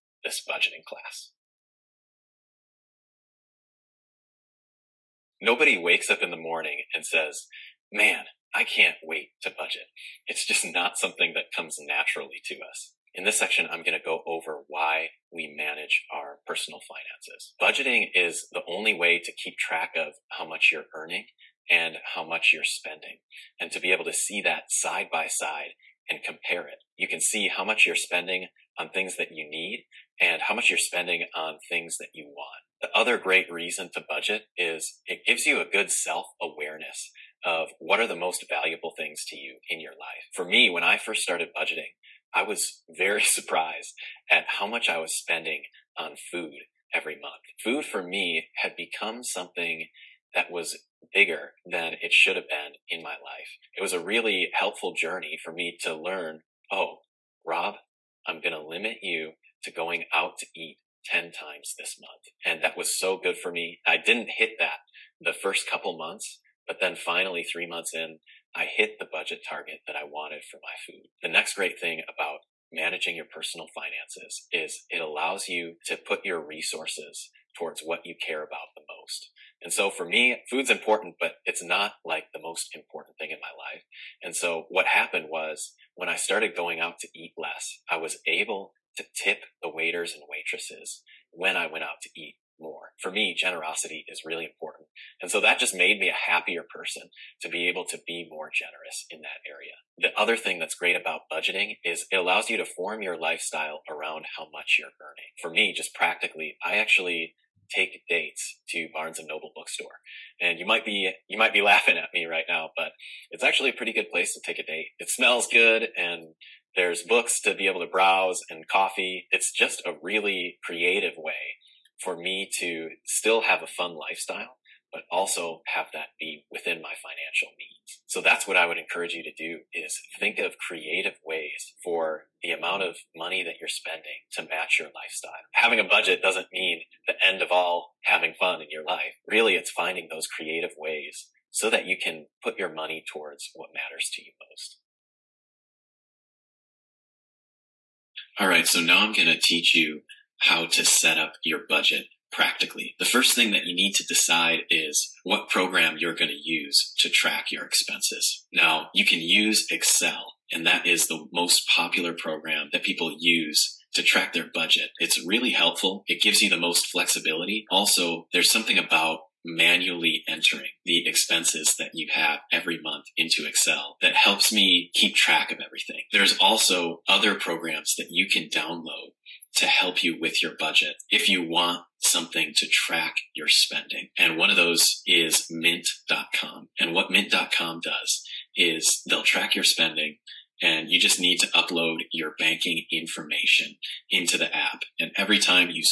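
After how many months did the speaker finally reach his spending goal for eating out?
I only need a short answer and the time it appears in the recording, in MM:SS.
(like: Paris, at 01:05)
3, at 01:07.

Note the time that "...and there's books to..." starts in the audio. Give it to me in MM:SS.
01:55.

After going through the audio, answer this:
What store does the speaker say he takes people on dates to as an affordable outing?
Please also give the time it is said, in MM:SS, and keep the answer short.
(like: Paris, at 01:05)
Barnes and Noble, at 01:48.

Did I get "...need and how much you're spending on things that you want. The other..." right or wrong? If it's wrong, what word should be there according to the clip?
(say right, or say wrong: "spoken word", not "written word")
right.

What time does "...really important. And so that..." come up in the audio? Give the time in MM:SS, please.
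01:34.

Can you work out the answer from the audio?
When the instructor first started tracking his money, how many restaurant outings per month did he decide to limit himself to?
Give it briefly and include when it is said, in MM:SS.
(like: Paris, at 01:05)
10, at 01:01.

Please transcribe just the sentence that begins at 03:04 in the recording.
And one of those is mint.com.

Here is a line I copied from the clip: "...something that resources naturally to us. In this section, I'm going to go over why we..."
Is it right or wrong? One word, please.
wrong.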